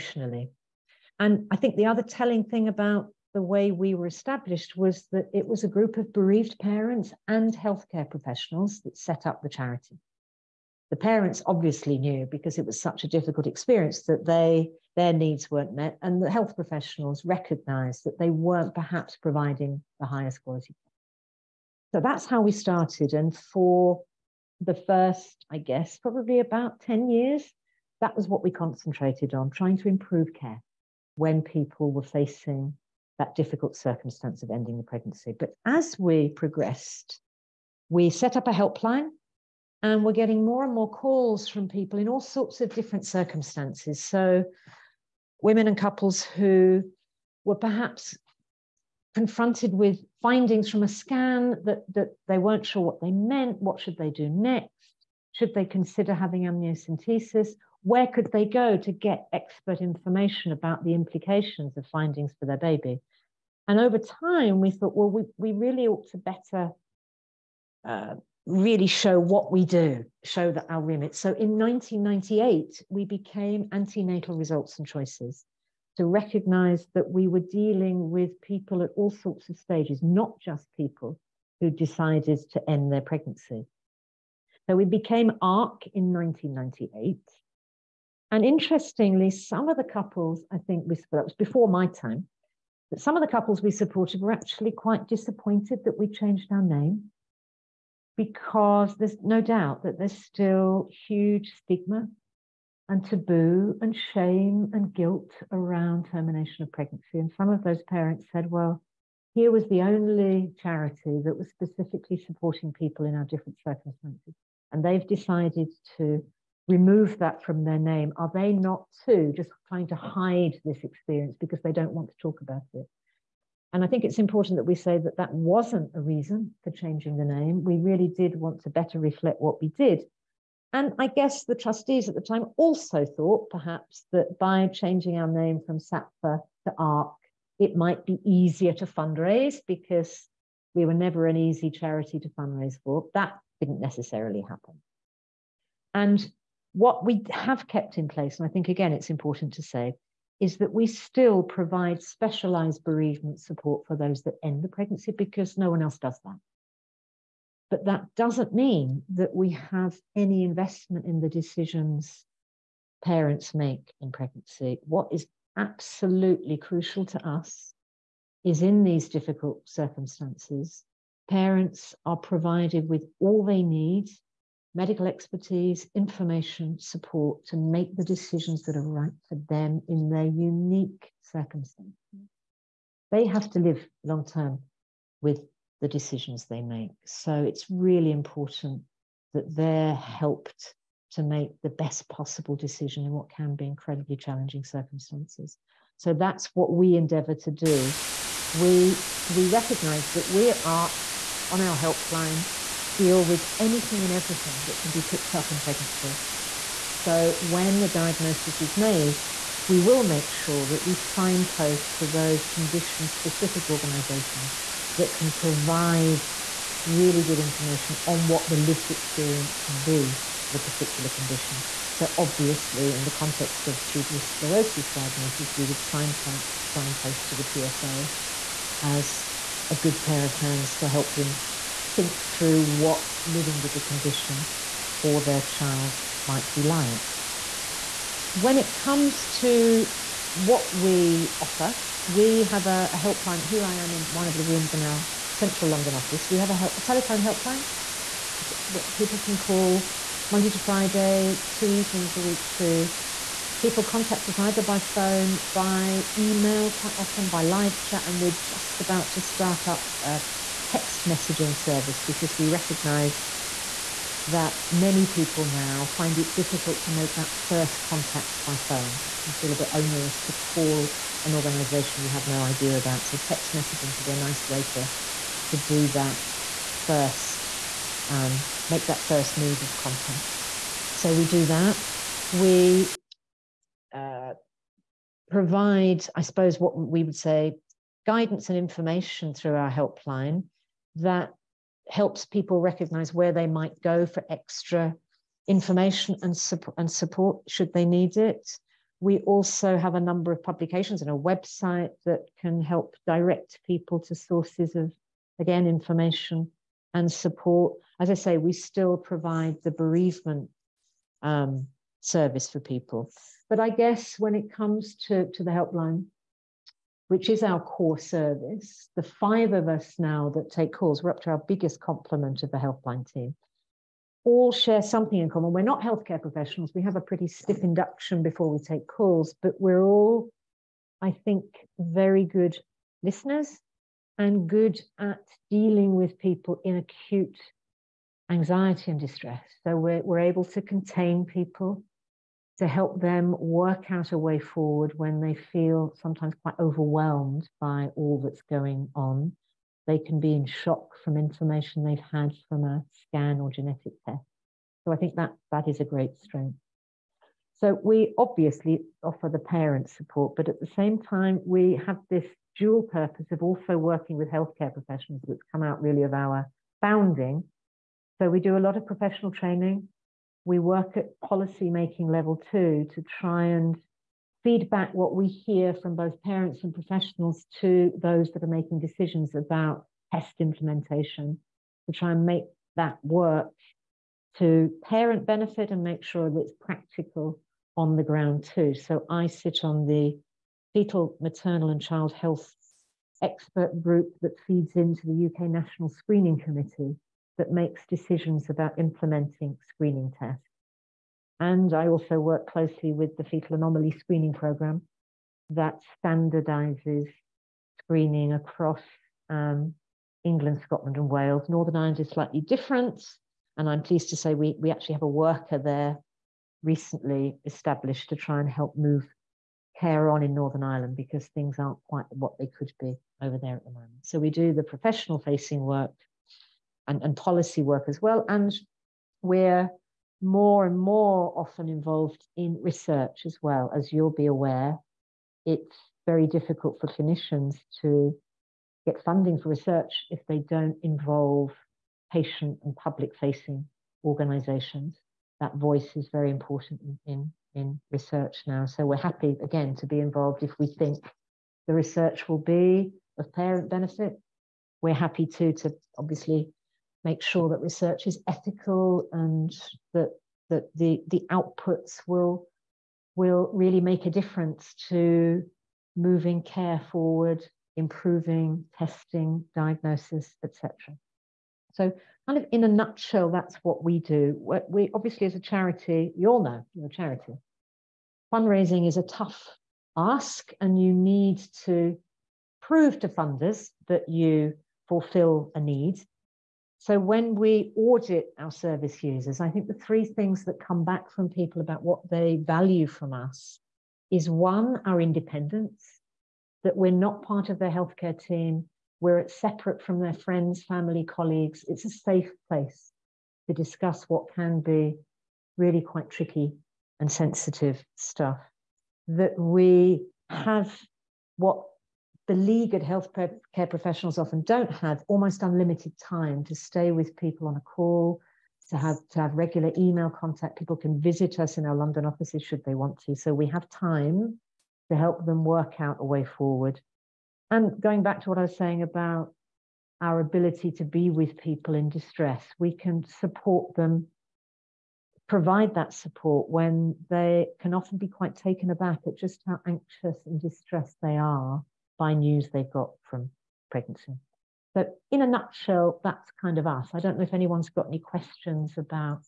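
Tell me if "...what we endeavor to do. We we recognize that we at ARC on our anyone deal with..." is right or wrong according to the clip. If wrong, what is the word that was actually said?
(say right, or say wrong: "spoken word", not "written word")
wrong: "helpline", not "anyone".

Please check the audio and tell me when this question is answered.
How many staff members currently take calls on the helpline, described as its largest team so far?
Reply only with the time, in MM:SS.
05:19.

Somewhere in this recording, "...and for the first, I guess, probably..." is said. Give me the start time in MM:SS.
00:23.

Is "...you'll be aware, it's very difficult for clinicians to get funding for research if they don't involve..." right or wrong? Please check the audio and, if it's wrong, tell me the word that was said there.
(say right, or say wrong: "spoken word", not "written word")
right.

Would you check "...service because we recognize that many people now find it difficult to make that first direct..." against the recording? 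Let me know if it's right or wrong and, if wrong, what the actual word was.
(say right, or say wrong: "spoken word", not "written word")
wrong: "contact", not "direct".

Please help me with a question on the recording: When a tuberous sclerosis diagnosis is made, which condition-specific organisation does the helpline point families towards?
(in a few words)
TSA.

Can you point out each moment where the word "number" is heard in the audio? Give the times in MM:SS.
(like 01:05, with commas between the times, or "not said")
04:59.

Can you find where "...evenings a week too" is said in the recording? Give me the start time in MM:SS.
04:11.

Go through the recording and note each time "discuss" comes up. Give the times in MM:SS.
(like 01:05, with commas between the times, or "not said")
08:23.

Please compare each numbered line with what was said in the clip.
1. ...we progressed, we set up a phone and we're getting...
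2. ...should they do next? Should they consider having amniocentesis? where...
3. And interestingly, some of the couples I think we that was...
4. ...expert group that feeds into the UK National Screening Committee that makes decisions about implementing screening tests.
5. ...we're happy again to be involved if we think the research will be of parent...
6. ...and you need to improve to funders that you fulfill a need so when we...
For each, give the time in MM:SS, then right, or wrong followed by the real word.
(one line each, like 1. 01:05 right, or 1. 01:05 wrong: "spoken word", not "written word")
1. 00:35 wrong: "helpline", not "phone"
2. 00:53 right
3. 01:28 right
4. 06:33 right
5. 07:28 right
6. 08:00 wrong: "prove", not "improve".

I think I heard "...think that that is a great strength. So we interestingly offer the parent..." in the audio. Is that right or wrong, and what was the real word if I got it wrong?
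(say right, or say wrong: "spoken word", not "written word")
wrong: "obviously", not "interestingly".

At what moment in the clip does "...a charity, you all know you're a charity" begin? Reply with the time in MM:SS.
07:55.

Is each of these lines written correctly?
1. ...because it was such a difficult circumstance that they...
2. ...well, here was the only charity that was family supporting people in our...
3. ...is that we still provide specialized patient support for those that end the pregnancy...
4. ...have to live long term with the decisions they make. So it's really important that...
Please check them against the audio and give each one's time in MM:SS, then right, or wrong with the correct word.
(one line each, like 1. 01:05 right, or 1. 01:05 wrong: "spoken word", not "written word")
1. 00:12 wrong: "experience", not "circumstance"
2. 01:48 wrong: "specifically", not "family"
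3. 02:30 wrong: "bereavement", not "patient"
4. 03:03 right.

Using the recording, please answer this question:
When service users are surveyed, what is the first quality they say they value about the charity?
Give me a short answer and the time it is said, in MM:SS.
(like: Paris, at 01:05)
Independence, at 08:14.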